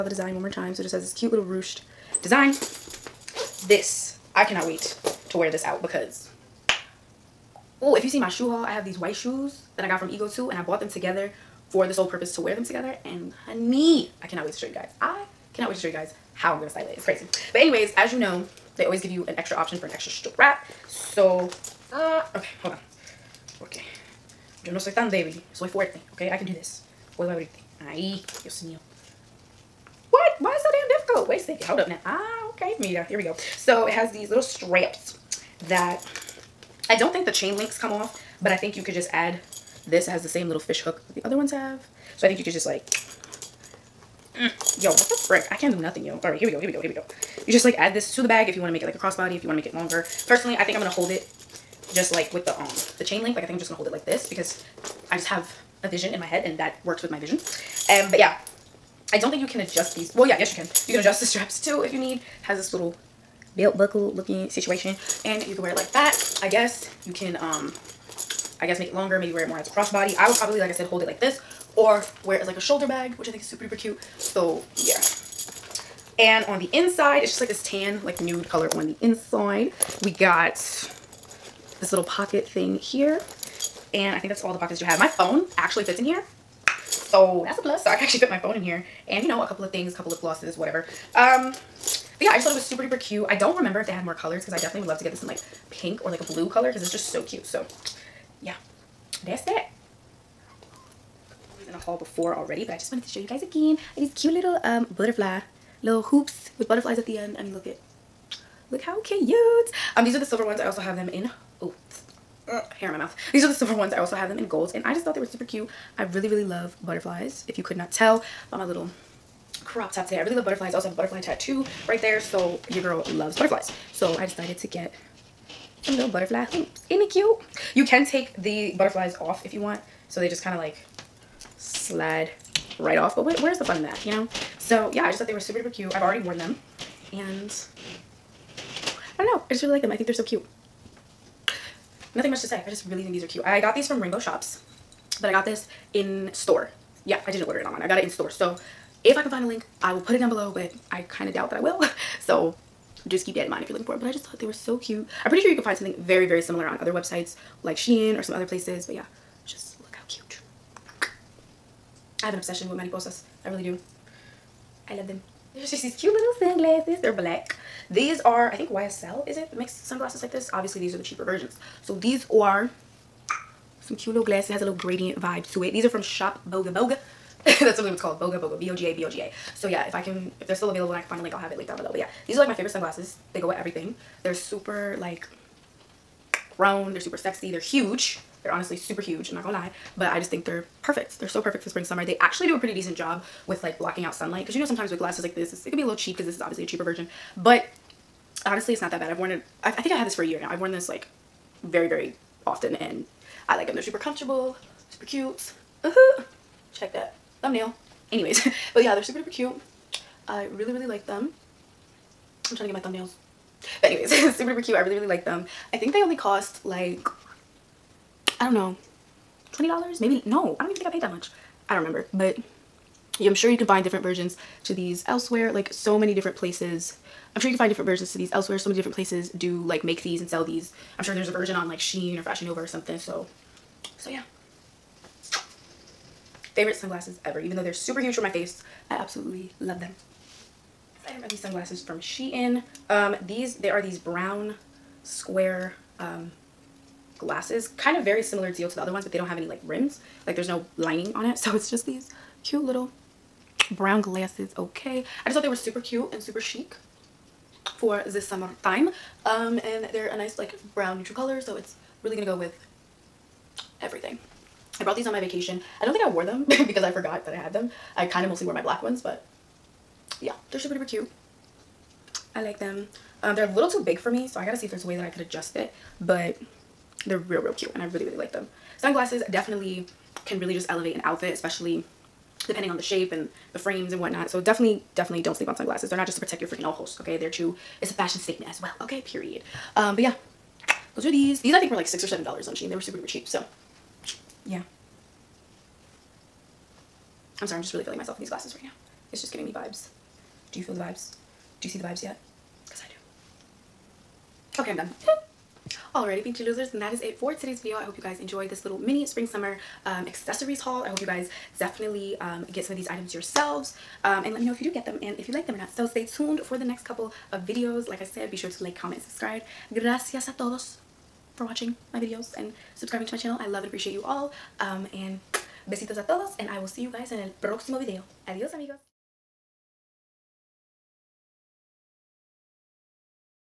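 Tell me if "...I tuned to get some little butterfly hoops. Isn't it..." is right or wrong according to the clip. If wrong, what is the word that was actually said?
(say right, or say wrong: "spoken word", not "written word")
wrong: "decided", not "tuned".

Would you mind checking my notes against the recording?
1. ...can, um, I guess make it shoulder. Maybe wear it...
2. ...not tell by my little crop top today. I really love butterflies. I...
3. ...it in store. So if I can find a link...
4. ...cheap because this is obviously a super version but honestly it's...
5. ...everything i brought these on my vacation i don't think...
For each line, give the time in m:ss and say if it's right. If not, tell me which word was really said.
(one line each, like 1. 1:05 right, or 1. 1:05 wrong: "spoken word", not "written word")
1. 1:07 wrong: "longer", not "shoulder"
2. 1:57 right
3. 2:27 right
4. 3:15 wrong: "cheaper", not "super"
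5. 4:23 right.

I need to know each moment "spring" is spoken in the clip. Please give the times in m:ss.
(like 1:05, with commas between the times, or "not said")
3:11, 5:09.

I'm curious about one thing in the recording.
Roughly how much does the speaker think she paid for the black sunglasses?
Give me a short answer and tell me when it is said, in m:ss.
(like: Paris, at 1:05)
$20, at 3:39.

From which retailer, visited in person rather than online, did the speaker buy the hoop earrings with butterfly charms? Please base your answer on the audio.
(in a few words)
Rainbow Shops.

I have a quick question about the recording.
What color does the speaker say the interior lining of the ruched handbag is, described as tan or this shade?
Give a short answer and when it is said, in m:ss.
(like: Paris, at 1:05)
nude, at 1:18.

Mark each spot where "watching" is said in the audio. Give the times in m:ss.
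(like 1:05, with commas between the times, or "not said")
5:21.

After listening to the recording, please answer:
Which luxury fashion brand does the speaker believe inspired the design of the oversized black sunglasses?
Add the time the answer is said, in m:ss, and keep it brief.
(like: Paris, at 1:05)
YSL, at 2:48.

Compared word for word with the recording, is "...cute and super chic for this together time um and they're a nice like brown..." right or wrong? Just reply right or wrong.
wrong.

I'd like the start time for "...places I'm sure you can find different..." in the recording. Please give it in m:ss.
3:46.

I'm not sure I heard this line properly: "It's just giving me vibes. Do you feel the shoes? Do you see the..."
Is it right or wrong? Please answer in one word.
wrong.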